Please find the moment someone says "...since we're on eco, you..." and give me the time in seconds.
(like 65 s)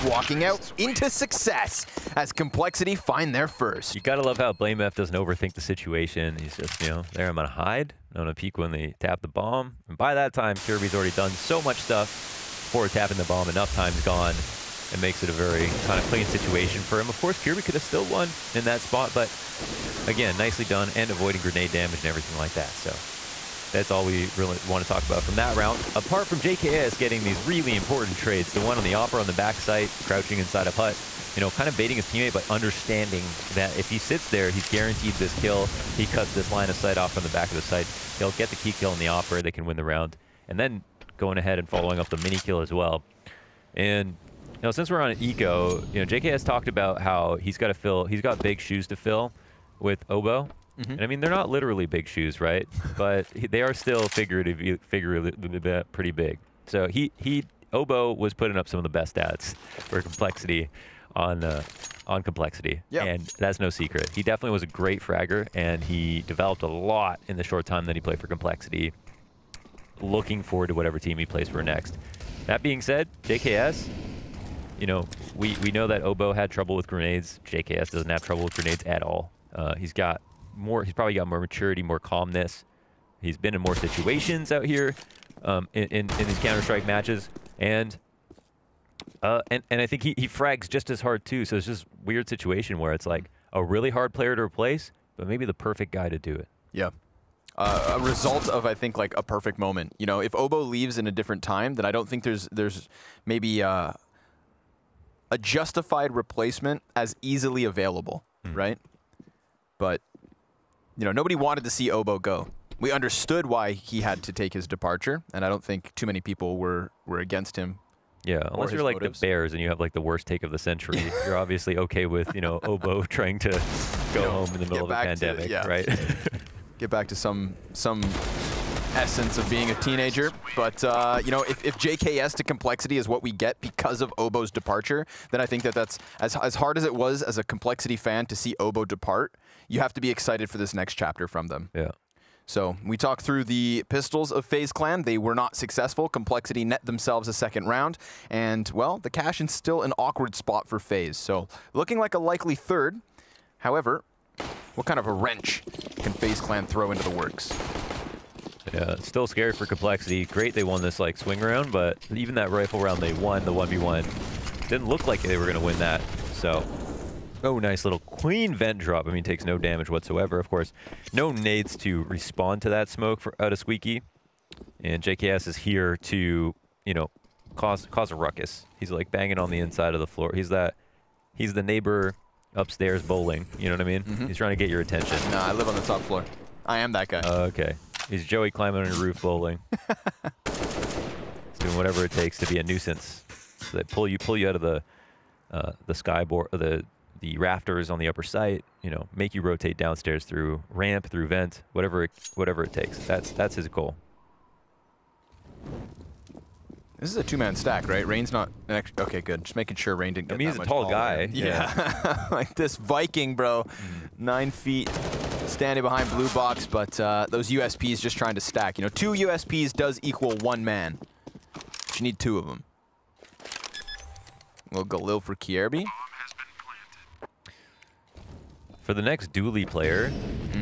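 44 s.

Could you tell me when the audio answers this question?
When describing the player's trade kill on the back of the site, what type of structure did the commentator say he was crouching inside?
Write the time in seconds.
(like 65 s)
30 s.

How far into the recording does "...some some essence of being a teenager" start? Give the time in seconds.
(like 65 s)
127 s.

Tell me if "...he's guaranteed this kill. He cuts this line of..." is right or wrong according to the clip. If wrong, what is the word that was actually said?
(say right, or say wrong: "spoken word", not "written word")
right.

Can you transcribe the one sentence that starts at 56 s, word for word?
So he, he, oBo was putting up some of the best stats for complexity on uh, on complexity.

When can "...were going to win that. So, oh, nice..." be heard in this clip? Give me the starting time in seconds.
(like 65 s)
165 s.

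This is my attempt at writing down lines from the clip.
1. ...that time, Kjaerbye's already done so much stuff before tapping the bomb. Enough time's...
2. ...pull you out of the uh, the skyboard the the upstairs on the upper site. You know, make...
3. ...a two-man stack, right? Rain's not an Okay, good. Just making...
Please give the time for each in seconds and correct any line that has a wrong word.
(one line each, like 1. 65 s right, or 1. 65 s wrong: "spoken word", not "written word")
1. 10 s right
2. 194 s wrong: "rafters", not "upstairs"
3. 207 s right.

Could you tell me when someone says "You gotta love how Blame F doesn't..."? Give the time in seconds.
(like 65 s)
3 s.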